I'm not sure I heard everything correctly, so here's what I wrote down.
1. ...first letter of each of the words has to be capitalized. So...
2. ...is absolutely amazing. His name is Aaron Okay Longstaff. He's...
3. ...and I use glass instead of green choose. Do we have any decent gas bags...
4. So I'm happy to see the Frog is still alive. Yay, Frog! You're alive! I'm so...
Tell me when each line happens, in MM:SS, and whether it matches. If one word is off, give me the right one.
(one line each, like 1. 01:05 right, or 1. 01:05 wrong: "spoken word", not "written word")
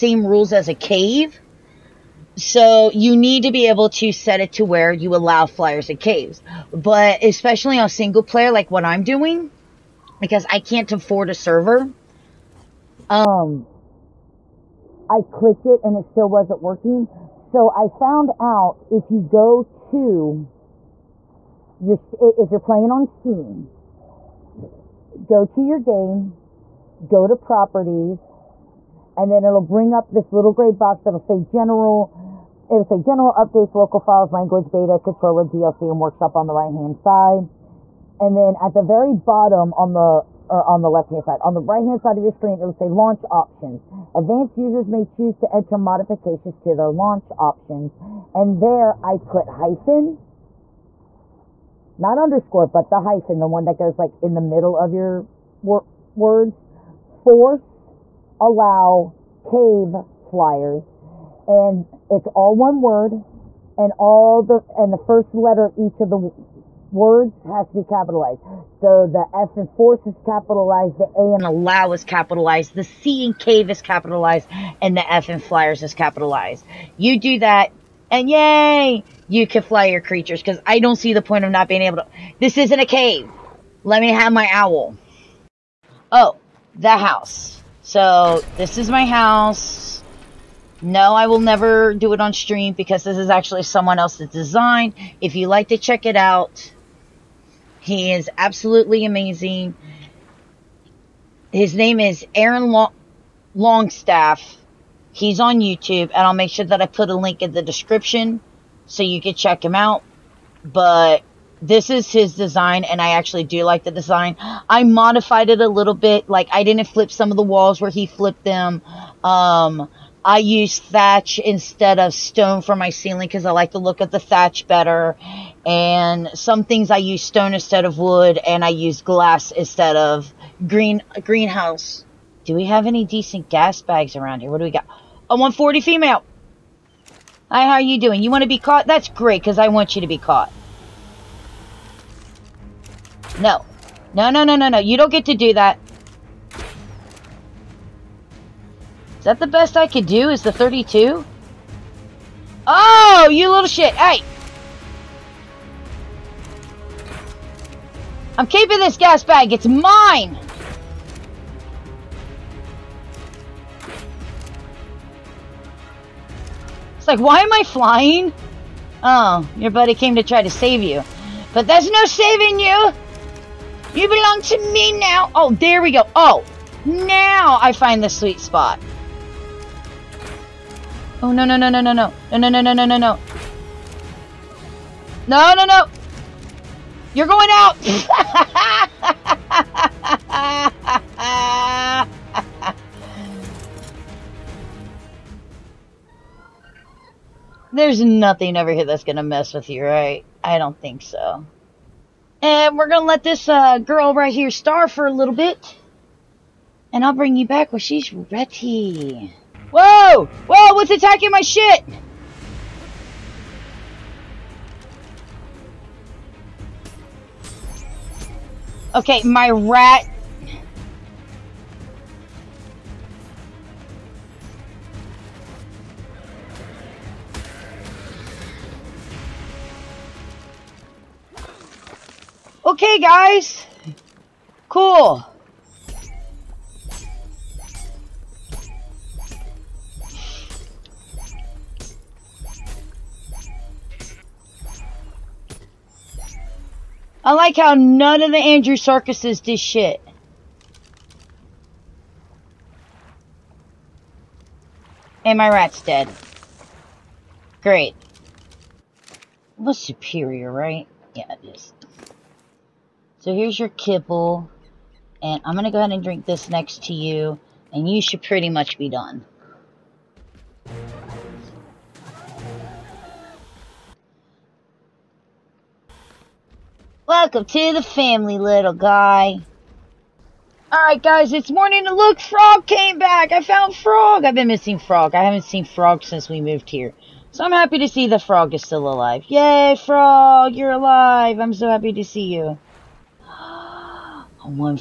1. 01:04 right
2. 01:38 wrong: "Long", not "Okay"
3. 02:08 wrong: "greenhouse", not "choose"
4. 04:47 right.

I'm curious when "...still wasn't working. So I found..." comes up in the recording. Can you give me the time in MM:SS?
00:16.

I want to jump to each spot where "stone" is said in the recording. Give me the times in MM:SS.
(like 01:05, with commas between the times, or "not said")
02:02, 02:07.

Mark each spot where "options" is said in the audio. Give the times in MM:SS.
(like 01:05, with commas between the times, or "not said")
00:43, 00:47.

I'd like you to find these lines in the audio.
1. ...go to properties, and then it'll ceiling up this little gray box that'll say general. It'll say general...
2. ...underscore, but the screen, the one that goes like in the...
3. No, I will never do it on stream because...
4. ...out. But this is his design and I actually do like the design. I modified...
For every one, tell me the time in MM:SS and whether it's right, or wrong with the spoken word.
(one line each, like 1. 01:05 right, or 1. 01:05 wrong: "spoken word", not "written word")
1. 00:27 wrong: "bring", not "ceiling"
2. 00:52 wrong: "hyphen", not "screen"
3. 01:30 right
4. 01:49 right.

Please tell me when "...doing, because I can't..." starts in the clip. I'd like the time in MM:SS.
00:09.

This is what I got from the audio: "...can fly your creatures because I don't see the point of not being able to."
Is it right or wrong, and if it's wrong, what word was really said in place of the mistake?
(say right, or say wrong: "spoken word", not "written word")
right.